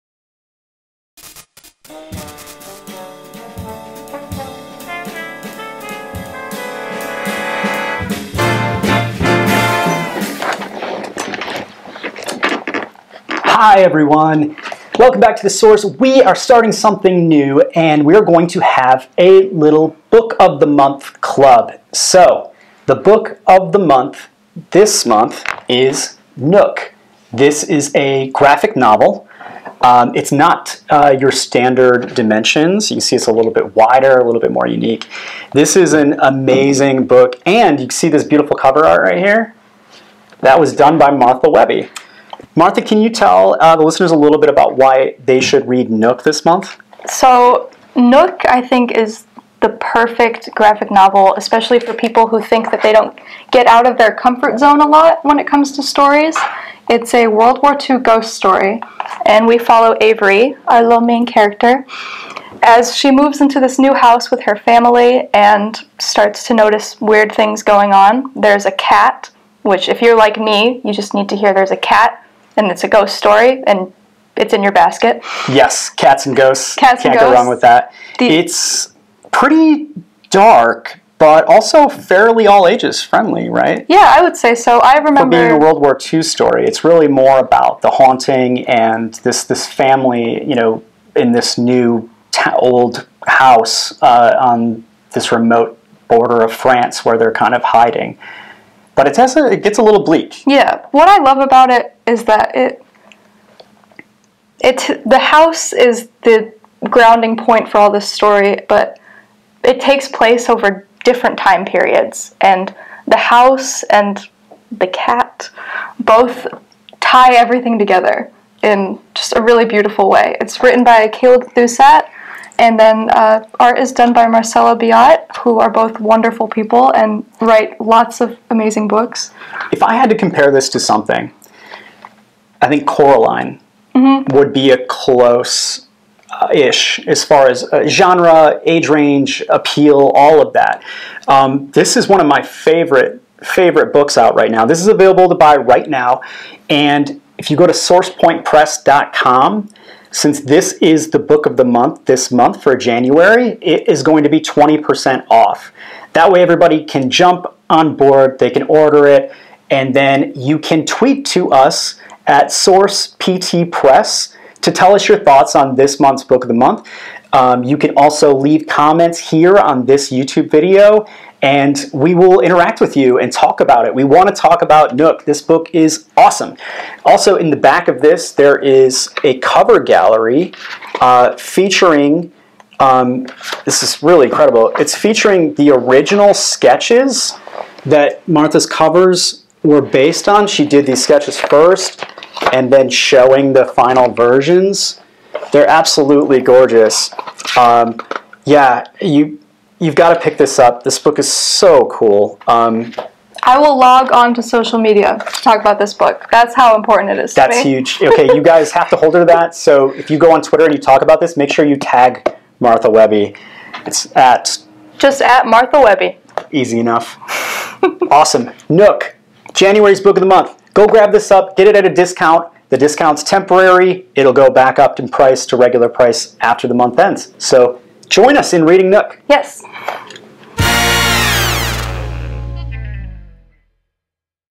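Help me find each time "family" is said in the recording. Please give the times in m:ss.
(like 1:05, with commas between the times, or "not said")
1:04, 1:29.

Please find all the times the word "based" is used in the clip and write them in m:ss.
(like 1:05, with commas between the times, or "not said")
3:09.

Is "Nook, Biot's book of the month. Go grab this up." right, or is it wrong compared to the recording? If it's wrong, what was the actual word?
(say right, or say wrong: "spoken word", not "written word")
wrong: "January", not "Biot".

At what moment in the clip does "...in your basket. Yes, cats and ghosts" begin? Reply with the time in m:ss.
1:14.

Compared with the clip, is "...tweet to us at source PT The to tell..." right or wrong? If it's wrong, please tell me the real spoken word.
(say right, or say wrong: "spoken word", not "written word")
wrong: "Press", not "The".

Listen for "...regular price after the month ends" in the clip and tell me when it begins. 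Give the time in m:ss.
3:45.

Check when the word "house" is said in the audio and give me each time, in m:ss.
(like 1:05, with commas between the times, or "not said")
1:03, 1:33, 1:45, 1:53.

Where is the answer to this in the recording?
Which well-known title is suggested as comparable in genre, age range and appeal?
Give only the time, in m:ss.
2:12.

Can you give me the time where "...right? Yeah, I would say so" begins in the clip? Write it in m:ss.
1:23.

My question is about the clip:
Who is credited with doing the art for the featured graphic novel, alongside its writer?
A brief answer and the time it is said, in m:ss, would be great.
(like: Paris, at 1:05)
Marcelo Biot, at 2:04.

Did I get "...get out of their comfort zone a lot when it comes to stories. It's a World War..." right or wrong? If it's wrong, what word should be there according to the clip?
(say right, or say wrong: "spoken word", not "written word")
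right.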